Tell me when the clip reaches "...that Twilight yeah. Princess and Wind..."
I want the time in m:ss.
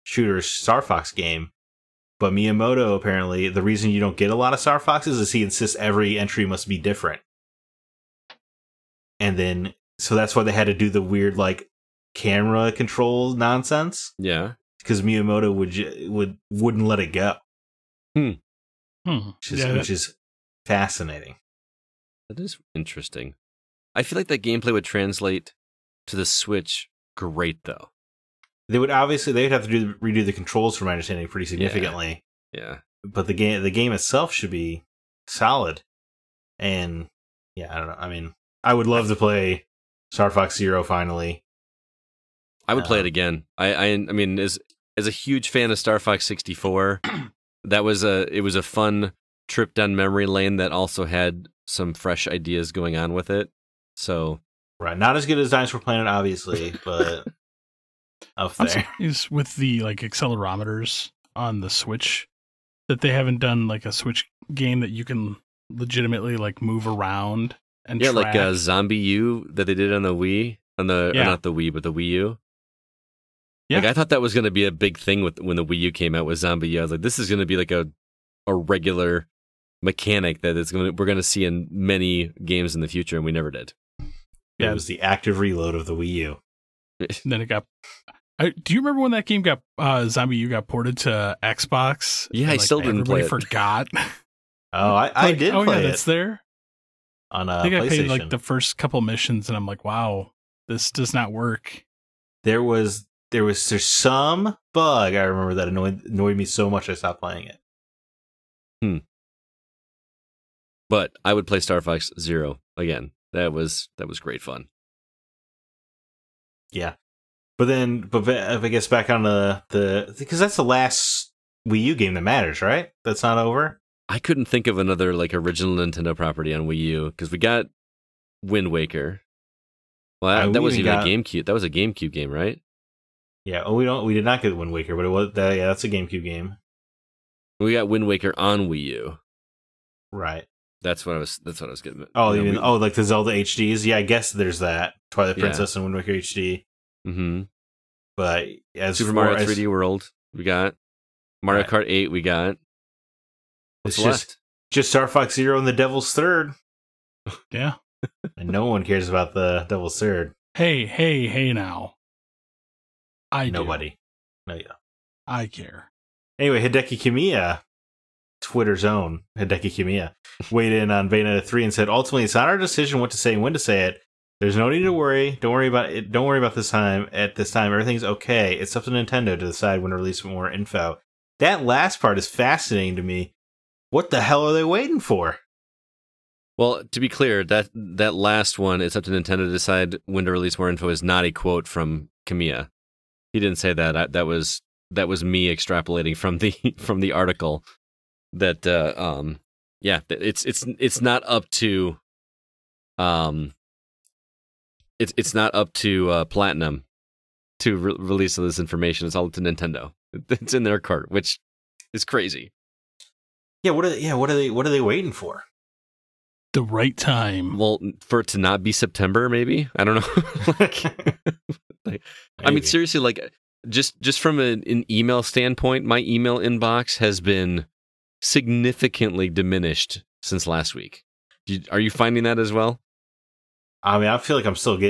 2:24.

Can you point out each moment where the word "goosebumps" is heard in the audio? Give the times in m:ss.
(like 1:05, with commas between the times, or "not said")
not said.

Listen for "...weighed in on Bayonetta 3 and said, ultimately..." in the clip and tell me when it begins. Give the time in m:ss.
2:50.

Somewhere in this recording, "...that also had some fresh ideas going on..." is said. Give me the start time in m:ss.
0:50.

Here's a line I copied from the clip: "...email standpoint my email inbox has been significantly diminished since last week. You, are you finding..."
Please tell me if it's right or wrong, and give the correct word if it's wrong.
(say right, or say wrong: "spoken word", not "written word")
right.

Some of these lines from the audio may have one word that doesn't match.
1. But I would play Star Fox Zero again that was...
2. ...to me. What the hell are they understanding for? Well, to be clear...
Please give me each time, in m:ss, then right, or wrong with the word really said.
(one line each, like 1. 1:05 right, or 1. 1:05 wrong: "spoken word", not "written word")
1. 1:50 right
2. 3:02 wrong: "waiting", not "understanding".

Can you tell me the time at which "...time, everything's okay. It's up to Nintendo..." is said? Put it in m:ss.
2:57.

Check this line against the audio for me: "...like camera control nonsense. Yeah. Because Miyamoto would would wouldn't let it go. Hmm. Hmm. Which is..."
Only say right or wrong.
right.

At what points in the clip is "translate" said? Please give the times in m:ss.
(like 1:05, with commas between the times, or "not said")
0:24.